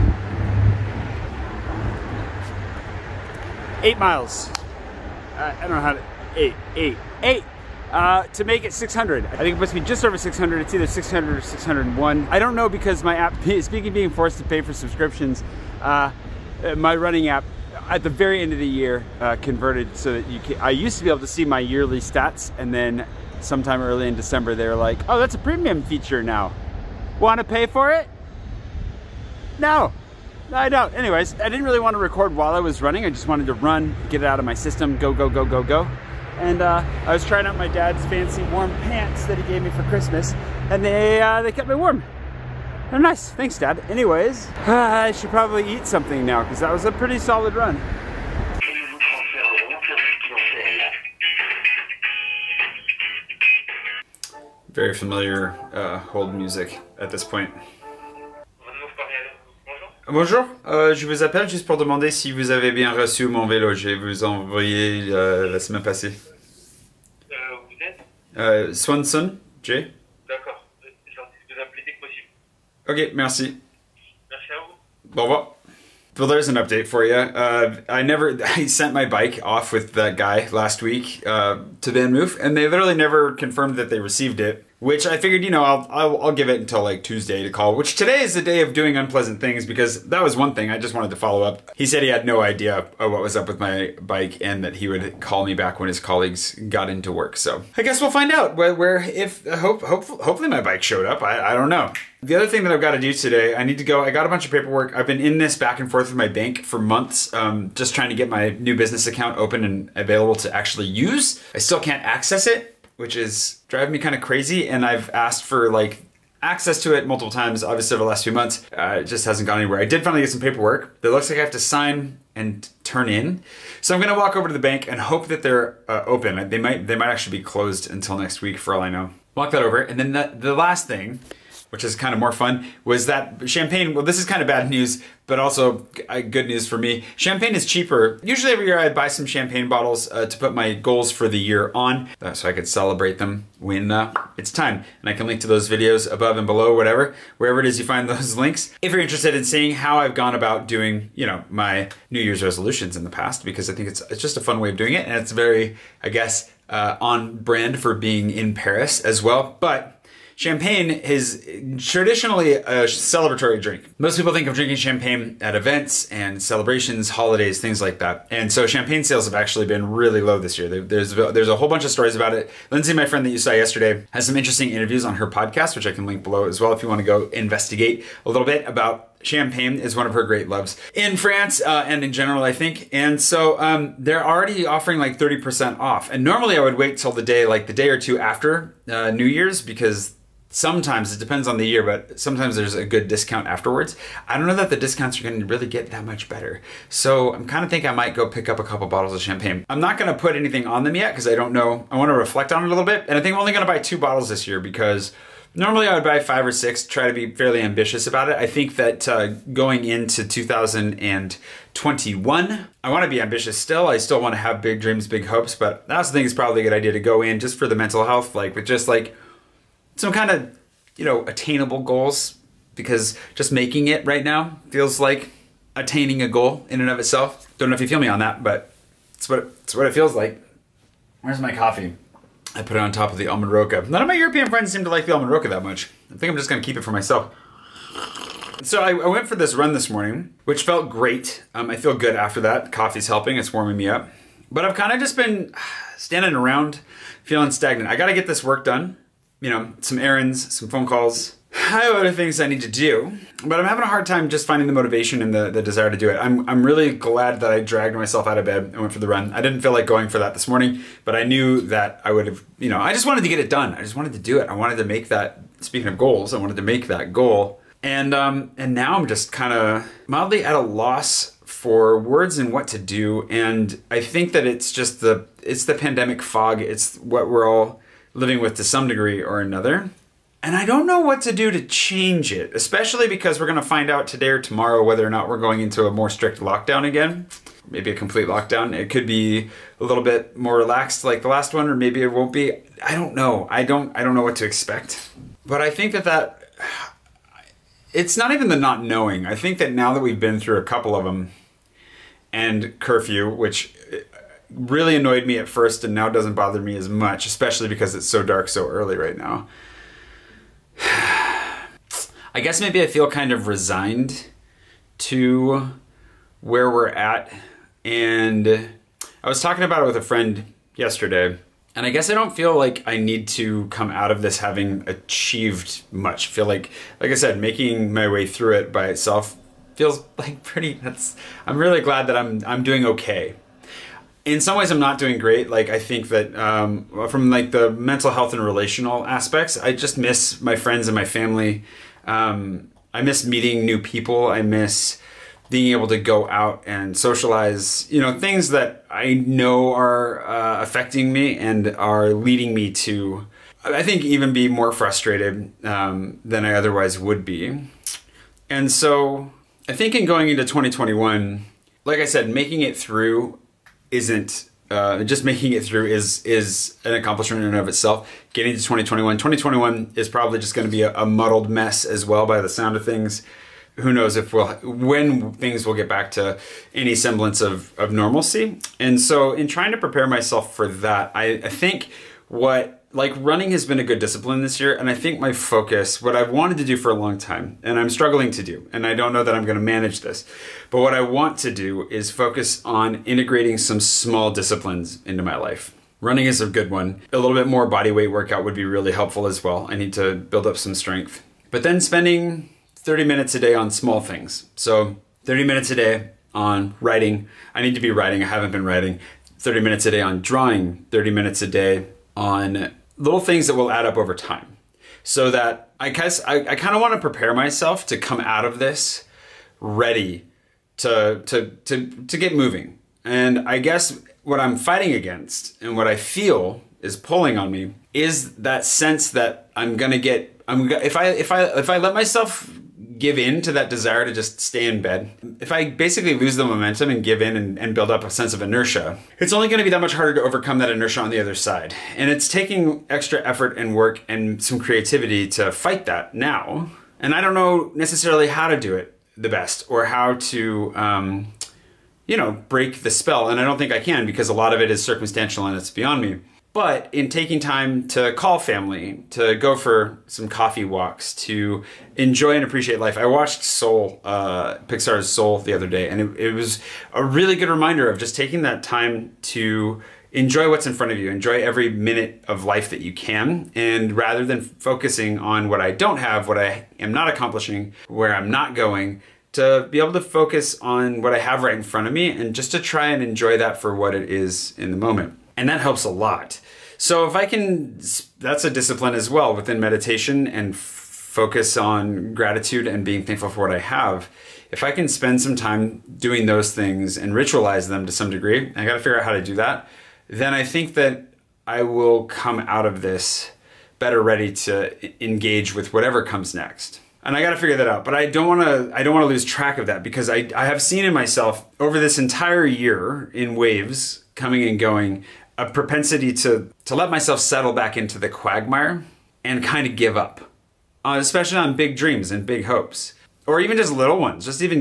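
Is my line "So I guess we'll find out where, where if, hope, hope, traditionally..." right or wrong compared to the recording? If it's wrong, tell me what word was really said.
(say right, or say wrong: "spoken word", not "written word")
wrong: "hopefully", not "traditionally".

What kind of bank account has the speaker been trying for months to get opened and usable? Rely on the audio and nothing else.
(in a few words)
business account.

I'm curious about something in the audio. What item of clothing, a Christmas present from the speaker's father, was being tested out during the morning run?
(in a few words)
warm pants.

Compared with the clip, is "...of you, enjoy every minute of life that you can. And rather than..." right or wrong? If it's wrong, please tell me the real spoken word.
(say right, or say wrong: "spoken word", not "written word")
right.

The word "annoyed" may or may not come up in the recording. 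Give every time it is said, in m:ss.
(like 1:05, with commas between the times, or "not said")
5:04.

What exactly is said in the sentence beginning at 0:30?
Anyways, I didn't really want to record while I was running.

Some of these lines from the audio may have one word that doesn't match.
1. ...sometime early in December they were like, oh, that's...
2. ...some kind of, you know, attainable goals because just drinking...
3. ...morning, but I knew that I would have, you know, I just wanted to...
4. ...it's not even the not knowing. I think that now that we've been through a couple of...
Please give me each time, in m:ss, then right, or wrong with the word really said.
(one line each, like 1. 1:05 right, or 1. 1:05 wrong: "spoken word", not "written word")
1. 0:23 right
2. 3:39 wrong: "making", not "drinking"
3. 4:20 right
4. 4:57 right.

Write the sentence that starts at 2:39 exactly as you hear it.
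But Champagne is traditionally a celebratory drink.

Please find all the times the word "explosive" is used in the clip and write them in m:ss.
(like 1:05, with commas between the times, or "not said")
not said.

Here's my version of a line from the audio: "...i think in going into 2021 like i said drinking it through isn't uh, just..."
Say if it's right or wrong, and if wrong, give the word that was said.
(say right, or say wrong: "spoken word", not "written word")
wrong: "making", not "drinking".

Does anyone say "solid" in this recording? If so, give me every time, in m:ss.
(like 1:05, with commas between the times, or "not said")
0:47.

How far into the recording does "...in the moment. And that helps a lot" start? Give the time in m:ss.
8:04.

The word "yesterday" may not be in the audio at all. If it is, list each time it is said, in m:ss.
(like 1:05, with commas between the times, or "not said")
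2:53, 5:20.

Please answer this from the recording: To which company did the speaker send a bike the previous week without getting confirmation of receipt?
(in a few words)
Van Move.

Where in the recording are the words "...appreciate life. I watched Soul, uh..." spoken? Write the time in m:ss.
7:42.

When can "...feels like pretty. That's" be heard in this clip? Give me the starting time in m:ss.
5:29.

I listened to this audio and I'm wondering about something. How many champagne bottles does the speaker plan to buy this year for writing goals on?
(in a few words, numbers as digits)
2.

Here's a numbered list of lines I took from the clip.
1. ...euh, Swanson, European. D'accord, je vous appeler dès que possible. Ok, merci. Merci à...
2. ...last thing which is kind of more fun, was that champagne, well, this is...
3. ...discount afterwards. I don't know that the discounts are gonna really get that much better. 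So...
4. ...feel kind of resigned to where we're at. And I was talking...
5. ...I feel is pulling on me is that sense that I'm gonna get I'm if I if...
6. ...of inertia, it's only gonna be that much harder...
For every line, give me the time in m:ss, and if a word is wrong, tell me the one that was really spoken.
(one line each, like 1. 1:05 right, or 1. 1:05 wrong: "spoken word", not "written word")
1. 1:08 wrong: "Jay", not "European"
2. 2:10 right
3. 3:13 right
4. 5:12 right
5. 7:05 right
6. 7:18 right.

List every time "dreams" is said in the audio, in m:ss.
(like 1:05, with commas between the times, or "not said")
3:34, 8:41.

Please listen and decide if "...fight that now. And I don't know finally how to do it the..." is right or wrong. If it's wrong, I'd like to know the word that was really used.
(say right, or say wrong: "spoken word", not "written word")
wrong: "necessarily", not "finally".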